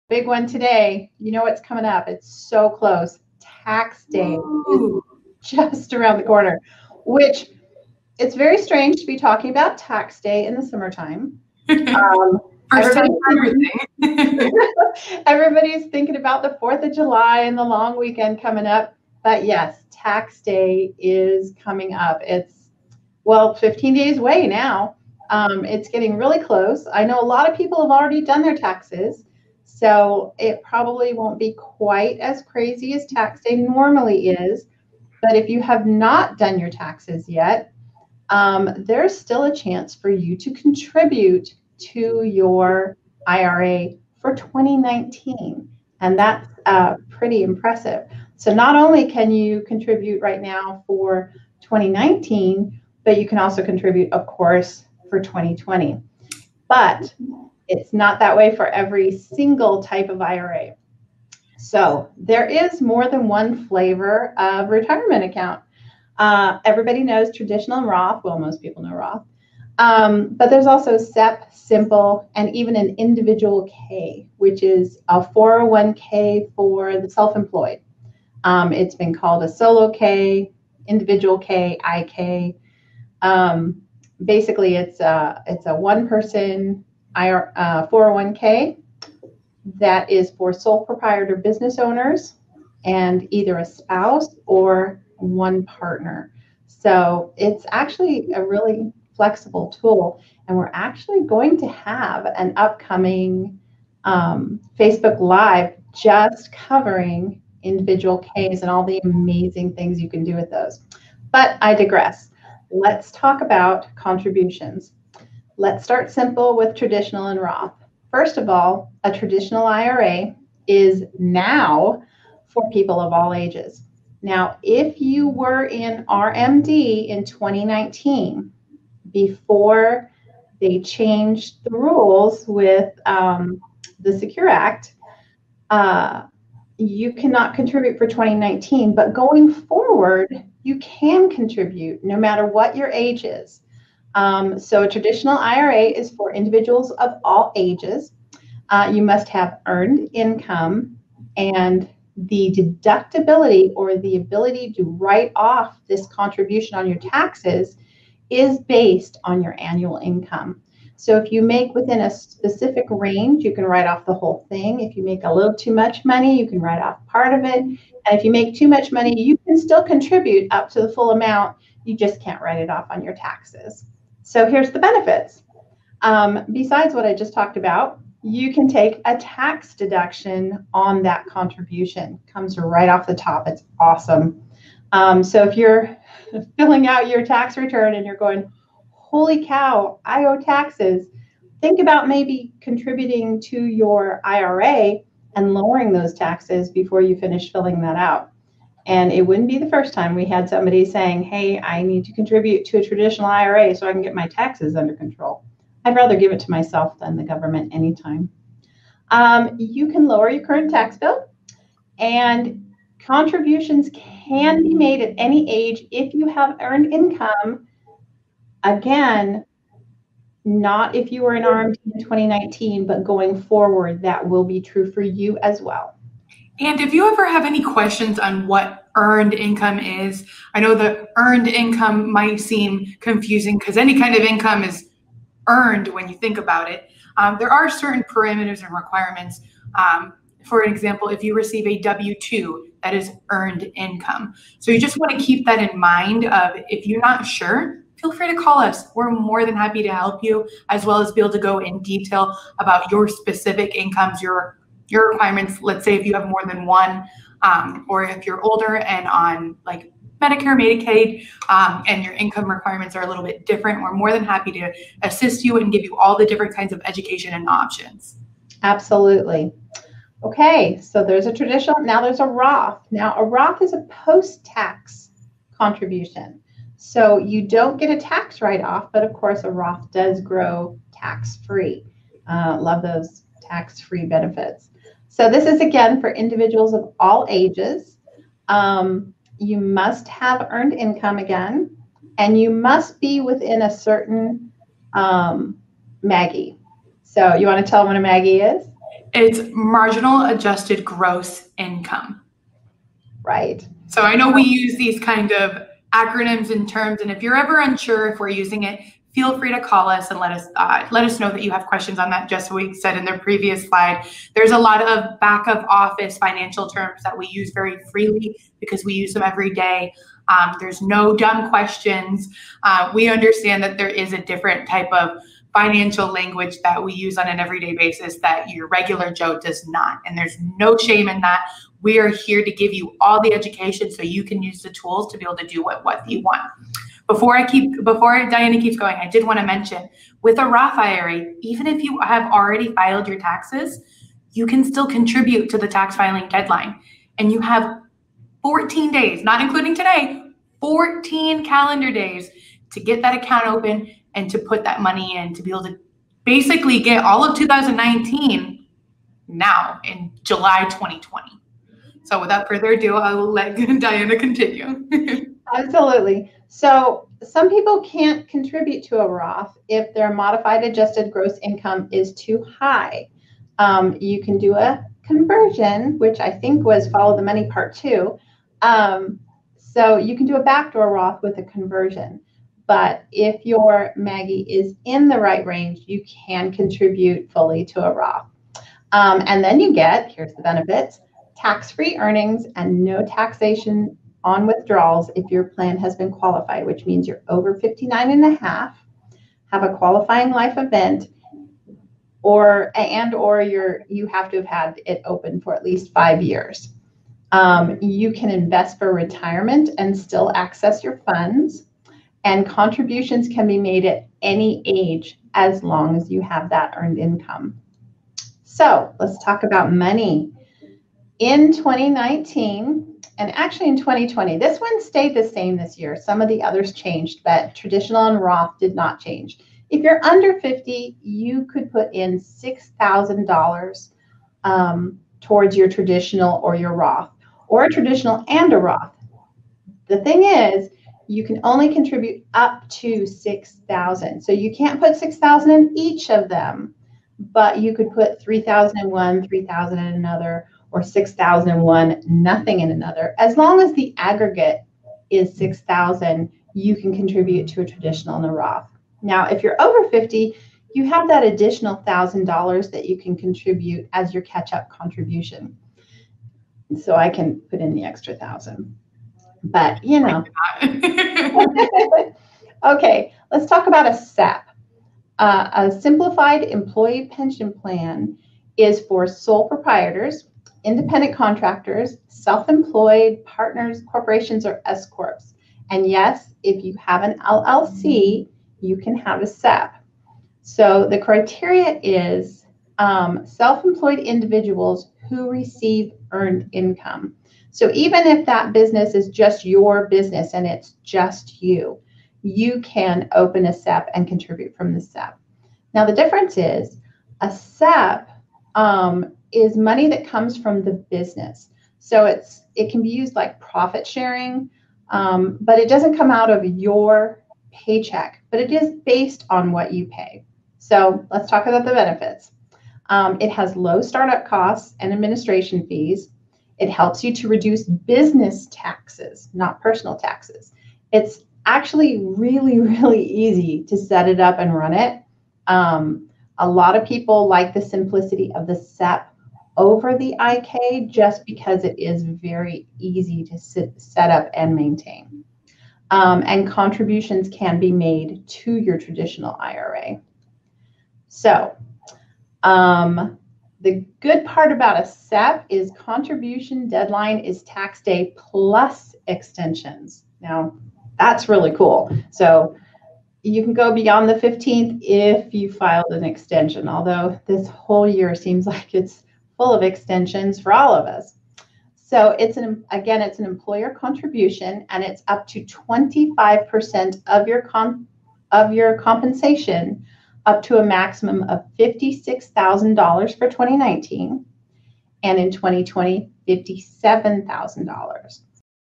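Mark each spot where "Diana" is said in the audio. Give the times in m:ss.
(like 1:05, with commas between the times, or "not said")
5:38, 6:03.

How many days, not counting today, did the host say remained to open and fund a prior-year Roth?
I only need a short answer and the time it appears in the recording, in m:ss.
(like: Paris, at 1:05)
14, at 5:50.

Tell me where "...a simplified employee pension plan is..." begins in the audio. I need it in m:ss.
7:55.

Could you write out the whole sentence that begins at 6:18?
Um, so you can do a backdoor Roth with a conversion.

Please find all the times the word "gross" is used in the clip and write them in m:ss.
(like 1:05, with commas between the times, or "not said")
5:00, 6:11.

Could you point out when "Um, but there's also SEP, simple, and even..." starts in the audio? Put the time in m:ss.
1:09.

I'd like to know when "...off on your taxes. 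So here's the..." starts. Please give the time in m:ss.
2:52.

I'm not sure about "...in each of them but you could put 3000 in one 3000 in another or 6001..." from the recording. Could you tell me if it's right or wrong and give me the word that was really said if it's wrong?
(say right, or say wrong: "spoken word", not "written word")
right.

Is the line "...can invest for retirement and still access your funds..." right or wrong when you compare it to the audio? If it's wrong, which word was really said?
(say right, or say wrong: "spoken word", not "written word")
right.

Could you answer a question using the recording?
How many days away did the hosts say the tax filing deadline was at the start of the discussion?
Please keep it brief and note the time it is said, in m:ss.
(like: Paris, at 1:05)
15, at 0:23.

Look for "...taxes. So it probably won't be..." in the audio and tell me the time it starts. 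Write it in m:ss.
0:28.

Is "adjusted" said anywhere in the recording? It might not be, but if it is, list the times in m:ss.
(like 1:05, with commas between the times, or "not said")
5:00, 6:10.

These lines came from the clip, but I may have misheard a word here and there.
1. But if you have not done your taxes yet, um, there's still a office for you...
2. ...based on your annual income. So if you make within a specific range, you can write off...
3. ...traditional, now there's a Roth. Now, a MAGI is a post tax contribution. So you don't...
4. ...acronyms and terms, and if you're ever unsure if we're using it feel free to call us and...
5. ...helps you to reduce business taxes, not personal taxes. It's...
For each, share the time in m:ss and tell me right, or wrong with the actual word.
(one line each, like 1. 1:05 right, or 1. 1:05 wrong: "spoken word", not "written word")
1. 0:35 wrong: "chance", not "office"
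2. 2:38 right
3. 4:31 wrong: "Roth", not "MAGI"
4. 5:05 right
5. 8:46 right.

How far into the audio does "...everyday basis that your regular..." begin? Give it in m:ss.
5:27.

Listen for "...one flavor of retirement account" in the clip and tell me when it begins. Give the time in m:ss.
1:03.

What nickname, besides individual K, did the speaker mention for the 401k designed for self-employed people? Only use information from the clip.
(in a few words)
solo K.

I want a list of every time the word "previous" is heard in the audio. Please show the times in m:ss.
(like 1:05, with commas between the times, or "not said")
5:13.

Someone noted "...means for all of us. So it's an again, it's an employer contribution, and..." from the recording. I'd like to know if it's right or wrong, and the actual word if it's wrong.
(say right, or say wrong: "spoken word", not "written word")
wrong: "extensions", not "means".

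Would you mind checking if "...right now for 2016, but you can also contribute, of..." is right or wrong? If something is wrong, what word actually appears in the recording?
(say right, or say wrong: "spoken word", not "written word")
wrong: "2019", not "2016".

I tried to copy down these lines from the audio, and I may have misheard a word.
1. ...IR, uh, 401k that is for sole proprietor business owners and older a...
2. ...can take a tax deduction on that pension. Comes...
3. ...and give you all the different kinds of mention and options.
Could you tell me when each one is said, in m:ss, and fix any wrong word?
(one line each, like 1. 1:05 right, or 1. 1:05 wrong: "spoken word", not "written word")
1. 1:27 wrong: "either", not "older"
2. 2:58 wrong: "contribution", not "pension"
3. 4:25 wrong: "education", not "mention".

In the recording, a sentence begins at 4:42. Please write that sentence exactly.
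Uh, love those tax free benefits.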